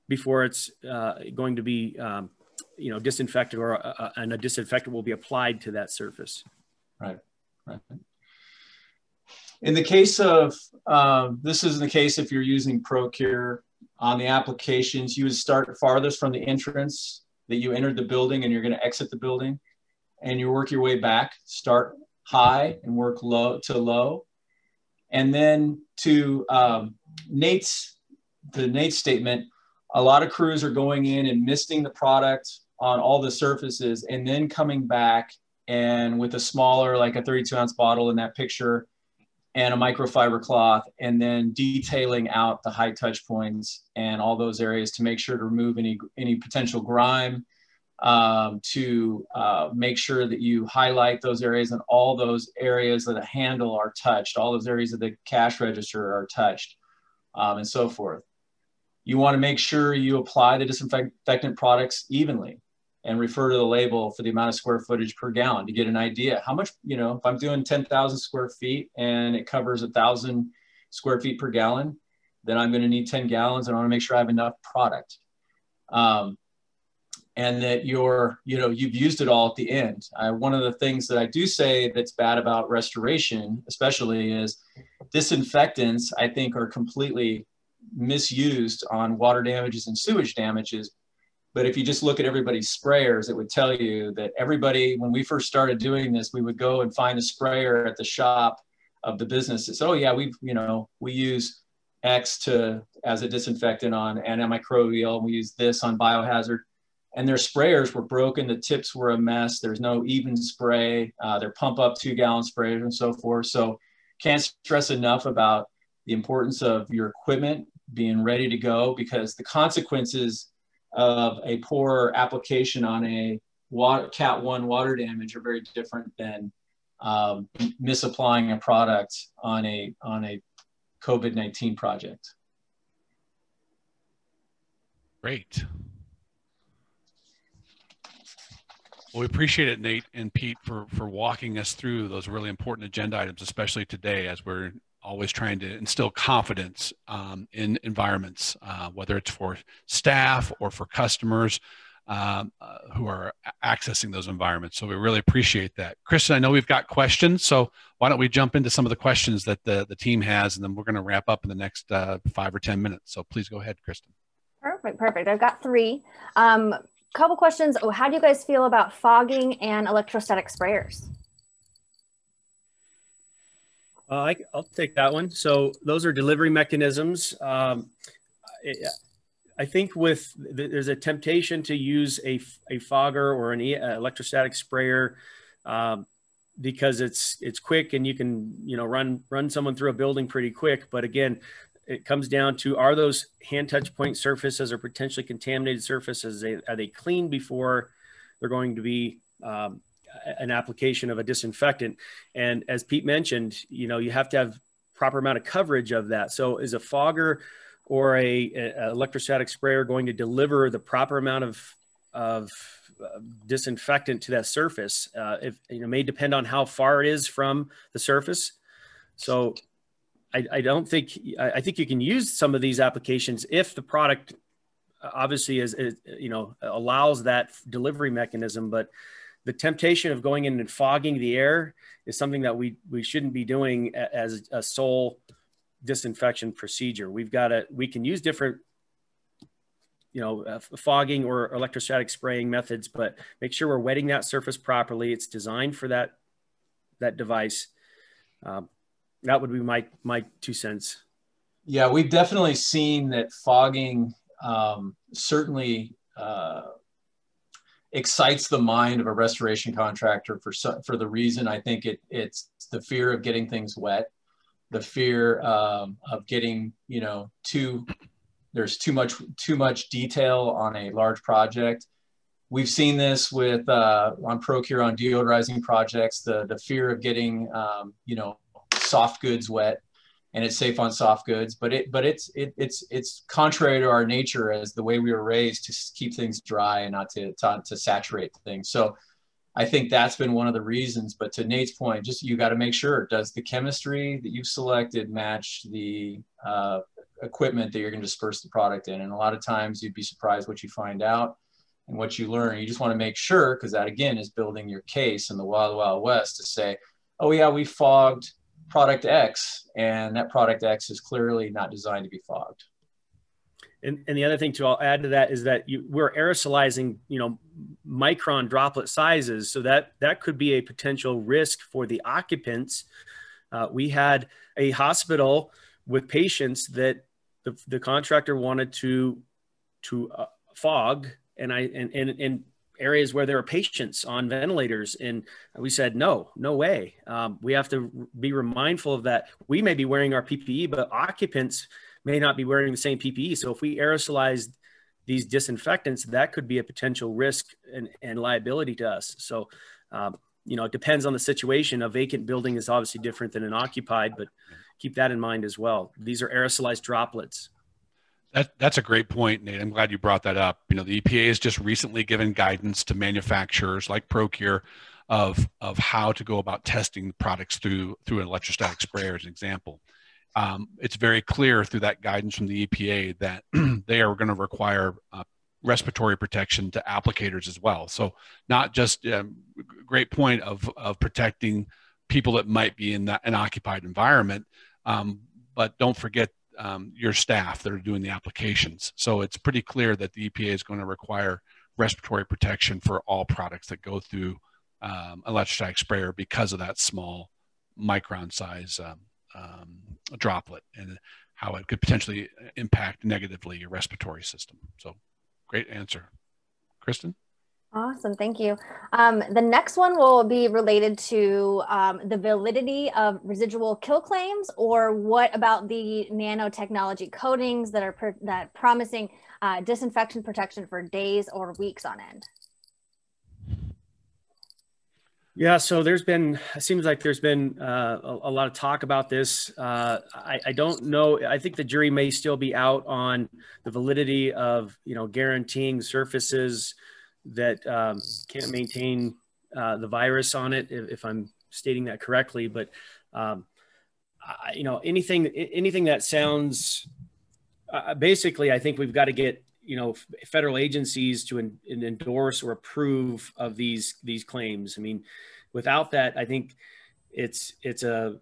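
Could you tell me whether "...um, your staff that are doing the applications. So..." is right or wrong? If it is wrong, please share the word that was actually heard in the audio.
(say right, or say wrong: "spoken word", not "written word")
right.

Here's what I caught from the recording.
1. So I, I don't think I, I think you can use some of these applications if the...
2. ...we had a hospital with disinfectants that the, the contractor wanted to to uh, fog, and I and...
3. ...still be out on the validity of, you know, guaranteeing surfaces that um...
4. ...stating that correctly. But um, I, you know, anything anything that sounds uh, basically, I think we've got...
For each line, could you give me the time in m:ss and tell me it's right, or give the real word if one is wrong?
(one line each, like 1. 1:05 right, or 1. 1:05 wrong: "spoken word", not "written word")
1. 3:39 right
2. 5:23 wrong: "patients", not "disinfectants"
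3. 7:12 right
4. 7:21 right.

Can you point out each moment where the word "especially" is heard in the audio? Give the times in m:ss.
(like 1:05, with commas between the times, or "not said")
1:23, 2:23.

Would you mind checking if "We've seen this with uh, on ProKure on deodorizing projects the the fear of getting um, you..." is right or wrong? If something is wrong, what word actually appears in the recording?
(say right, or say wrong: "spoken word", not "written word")
right.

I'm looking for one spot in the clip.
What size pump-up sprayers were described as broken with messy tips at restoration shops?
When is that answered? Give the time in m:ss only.
1:51.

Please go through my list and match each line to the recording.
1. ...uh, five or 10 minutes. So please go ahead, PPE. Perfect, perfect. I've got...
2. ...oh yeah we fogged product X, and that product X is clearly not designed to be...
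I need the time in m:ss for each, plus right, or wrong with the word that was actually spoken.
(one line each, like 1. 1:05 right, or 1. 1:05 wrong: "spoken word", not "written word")
1. 2:41 wrong: "Kristen", not "PPE"
2. 5:07 right.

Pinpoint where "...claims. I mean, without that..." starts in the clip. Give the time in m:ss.
7:34.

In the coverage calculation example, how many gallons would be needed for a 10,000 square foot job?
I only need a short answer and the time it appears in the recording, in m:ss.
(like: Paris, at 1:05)
10 gallons, at 1:13.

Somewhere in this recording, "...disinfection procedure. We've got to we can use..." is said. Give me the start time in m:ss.
3:55.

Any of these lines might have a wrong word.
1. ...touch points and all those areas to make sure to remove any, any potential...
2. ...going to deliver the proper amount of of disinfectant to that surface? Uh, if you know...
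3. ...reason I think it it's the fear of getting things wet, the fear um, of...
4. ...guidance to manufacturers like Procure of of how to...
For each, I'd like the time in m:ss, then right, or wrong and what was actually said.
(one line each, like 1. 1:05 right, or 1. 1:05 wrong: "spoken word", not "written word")
1. 0:42 right
2. 3:29 right
3. 4:21 right
4. 6:02 right.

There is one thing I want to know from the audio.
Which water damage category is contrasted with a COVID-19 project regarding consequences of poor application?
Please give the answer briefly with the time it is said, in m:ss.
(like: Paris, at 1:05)
cat one, at 2:04.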